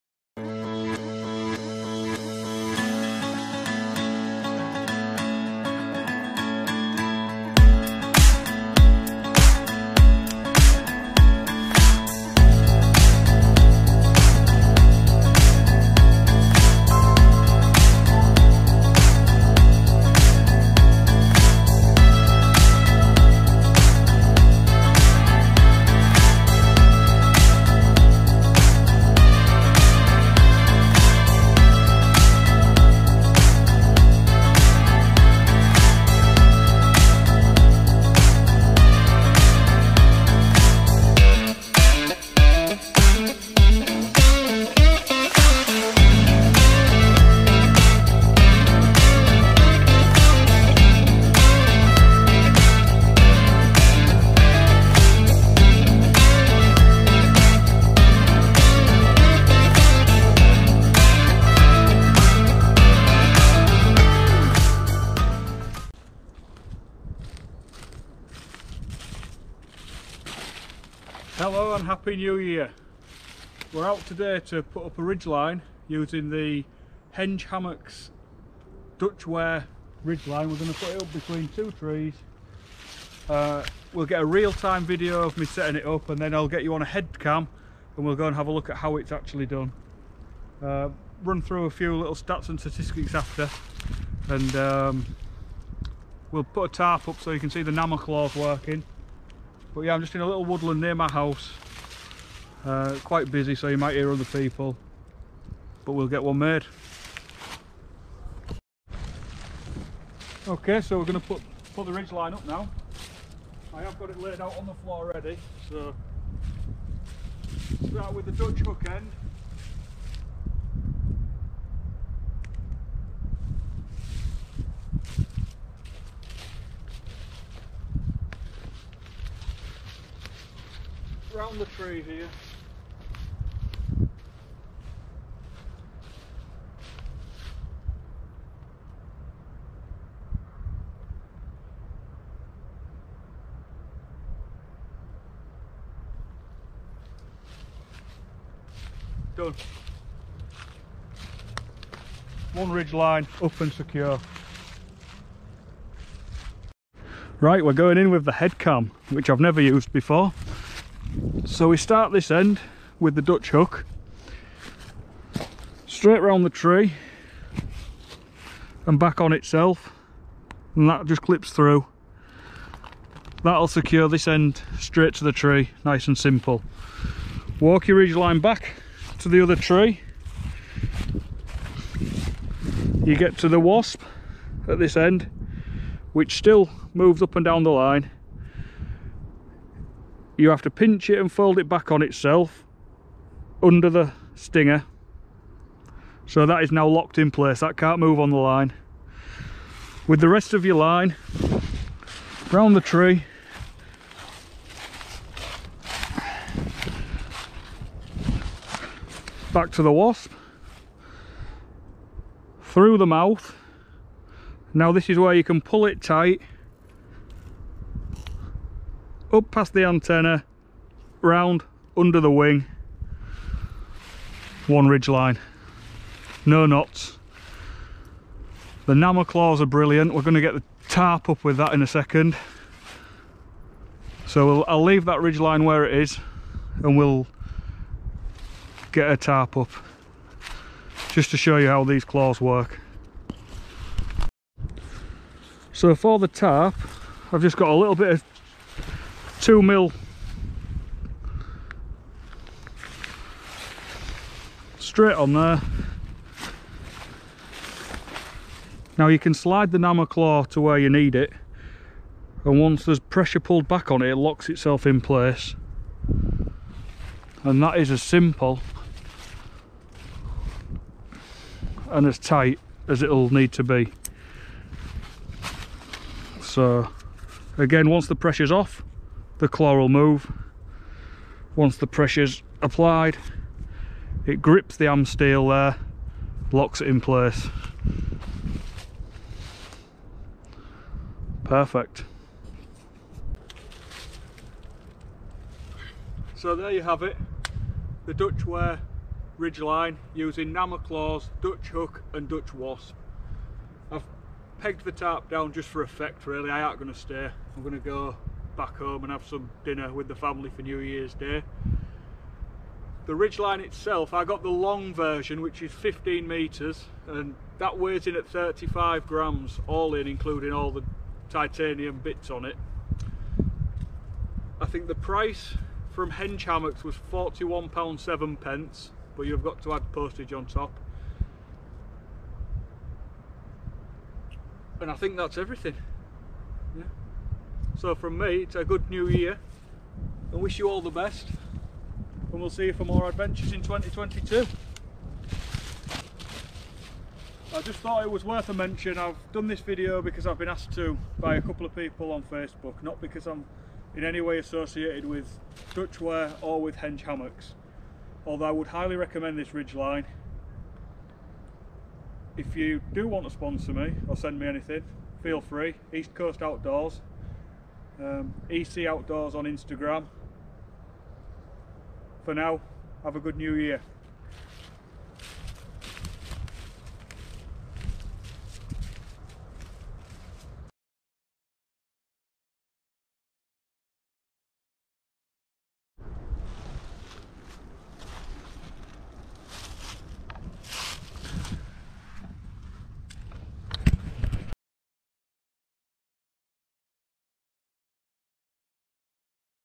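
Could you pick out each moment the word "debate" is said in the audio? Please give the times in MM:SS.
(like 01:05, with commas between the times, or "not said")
not said.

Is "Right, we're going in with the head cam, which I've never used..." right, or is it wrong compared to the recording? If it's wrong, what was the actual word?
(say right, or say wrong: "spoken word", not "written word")
right.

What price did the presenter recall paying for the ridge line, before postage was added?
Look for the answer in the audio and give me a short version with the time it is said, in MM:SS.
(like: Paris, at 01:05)
£41.07, at 05:27.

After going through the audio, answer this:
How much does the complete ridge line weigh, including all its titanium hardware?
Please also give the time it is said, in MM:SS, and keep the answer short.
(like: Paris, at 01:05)
35 grams, at 05:18.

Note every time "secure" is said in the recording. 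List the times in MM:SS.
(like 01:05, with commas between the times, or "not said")
02:33, 02:53.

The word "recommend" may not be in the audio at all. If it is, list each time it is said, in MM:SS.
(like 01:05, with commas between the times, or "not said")
05:58.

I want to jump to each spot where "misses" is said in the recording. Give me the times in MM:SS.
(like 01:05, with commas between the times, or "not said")
not said.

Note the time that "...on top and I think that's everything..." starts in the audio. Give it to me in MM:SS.
05:30.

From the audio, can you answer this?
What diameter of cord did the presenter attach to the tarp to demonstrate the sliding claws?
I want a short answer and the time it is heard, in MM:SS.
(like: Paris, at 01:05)
2 mil, at 04:09.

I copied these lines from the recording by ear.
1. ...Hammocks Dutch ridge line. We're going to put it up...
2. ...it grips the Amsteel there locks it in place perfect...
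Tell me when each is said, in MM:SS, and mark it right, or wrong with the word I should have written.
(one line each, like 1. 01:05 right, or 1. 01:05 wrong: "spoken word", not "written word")
1. 01:17 right
2. 04:44 right.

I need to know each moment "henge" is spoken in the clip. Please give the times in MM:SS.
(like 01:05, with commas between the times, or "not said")
01:17, 05:56.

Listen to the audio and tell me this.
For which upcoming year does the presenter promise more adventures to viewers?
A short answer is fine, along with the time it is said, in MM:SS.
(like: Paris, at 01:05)
2022, at 05:43.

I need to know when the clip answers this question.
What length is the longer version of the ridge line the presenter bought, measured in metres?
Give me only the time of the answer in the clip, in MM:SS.
05:15.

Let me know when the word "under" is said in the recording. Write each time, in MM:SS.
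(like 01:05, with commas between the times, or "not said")
03:13, 03:41.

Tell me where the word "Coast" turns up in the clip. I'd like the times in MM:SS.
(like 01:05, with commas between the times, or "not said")
06:06.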